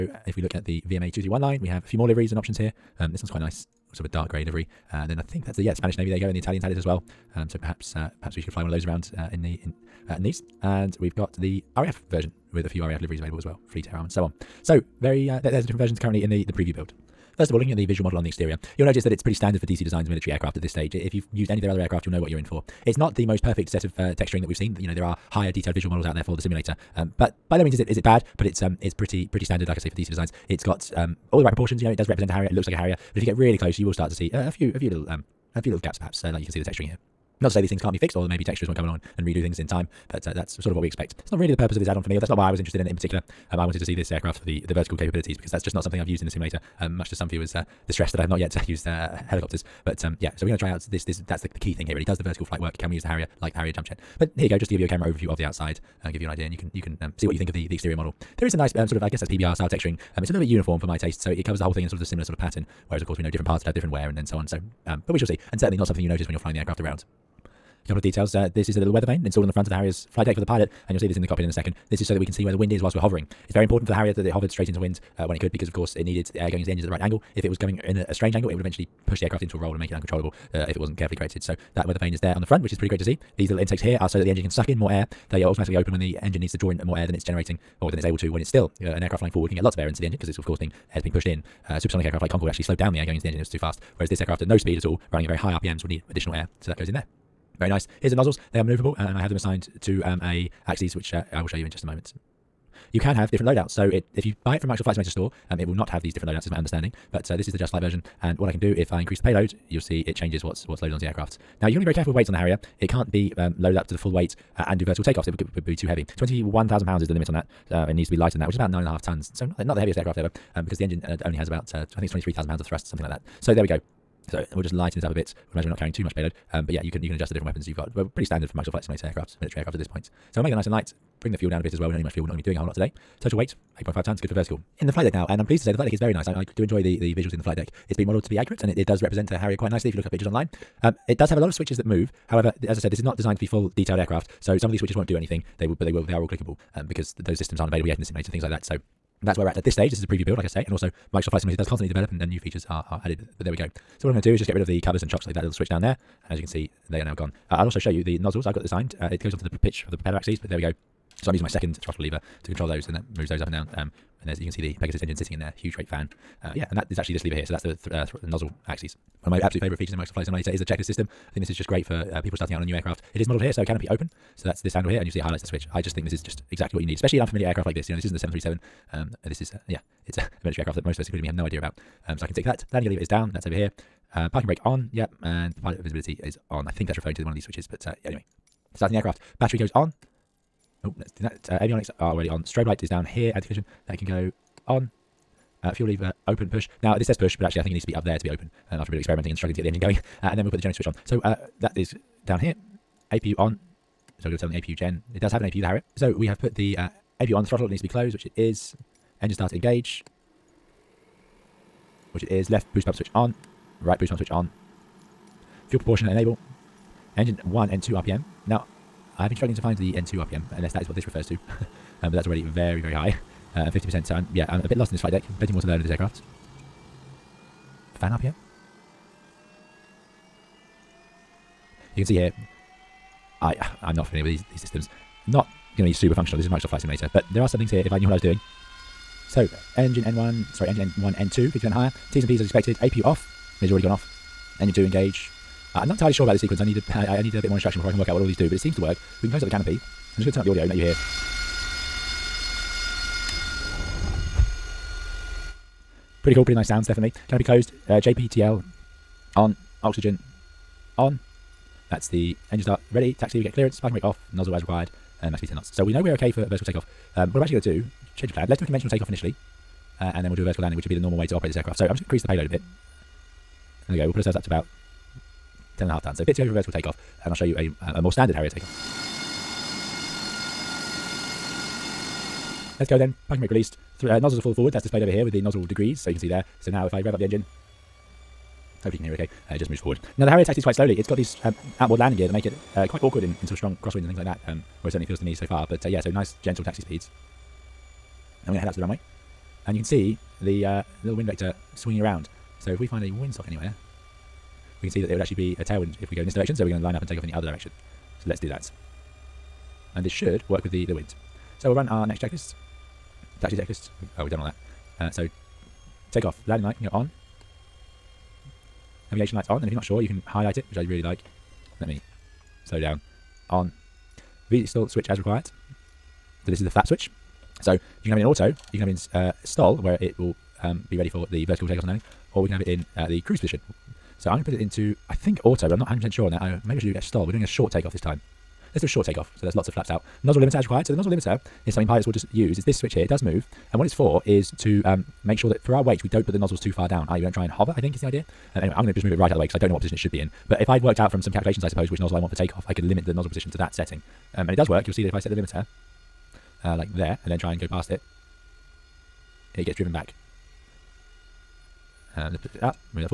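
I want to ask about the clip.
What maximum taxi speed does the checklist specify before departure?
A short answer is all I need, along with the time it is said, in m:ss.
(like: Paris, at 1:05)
10 knots, at 4:25.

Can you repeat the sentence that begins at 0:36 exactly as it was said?
Uh, like you can see the texturing here.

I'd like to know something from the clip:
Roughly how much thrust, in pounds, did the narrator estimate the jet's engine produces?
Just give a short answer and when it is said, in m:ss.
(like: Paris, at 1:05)
23,000 pounds, at 2:02.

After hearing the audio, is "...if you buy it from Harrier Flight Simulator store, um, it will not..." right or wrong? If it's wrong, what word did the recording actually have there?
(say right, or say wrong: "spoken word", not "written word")
wrong: "Microsoft", not "Harrier".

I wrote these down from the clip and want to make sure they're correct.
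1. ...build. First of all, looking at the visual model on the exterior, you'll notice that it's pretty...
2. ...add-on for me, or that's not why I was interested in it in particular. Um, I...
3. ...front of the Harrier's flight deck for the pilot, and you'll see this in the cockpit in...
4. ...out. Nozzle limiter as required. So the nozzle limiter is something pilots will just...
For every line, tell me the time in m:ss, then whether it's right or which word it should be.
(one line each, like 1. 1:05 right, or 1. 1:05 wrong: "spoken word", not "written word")
1. 0:16 right
2. 0:41 right
3. 1:09 right
4. 5:39 right.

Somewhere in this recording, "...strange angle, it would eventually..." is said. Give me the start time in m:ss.
1:18.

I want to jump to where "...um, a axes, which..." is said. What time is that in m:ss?
1:40.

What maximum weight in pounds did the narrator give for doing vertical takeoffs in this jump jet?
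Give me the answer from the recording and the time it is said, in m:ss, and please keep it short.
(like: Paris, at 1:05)
21,000 pounds, at 1:56.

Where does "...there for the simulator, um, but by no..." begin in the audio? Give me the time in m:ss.
0:26.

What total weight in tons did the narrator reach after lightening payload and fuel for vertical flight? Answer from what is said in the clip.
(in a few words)
8.5 tons.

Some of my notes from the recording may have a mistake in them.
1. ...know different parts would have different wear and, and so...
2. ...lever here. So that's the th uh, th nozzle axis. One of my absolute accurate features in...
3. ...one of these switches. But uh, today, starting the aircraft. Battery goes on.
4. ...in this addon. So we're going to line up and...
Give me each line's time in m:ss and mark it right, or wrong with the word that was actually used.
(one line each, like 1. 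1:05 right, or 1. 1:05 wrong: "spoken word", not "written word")
1. 1:03 right
2. 2:47 wrong: "favorite", not "accurate"
3. 3:07 wrong: "anyway", not "today"
4. 5:06 wrong: "direction", not "addon".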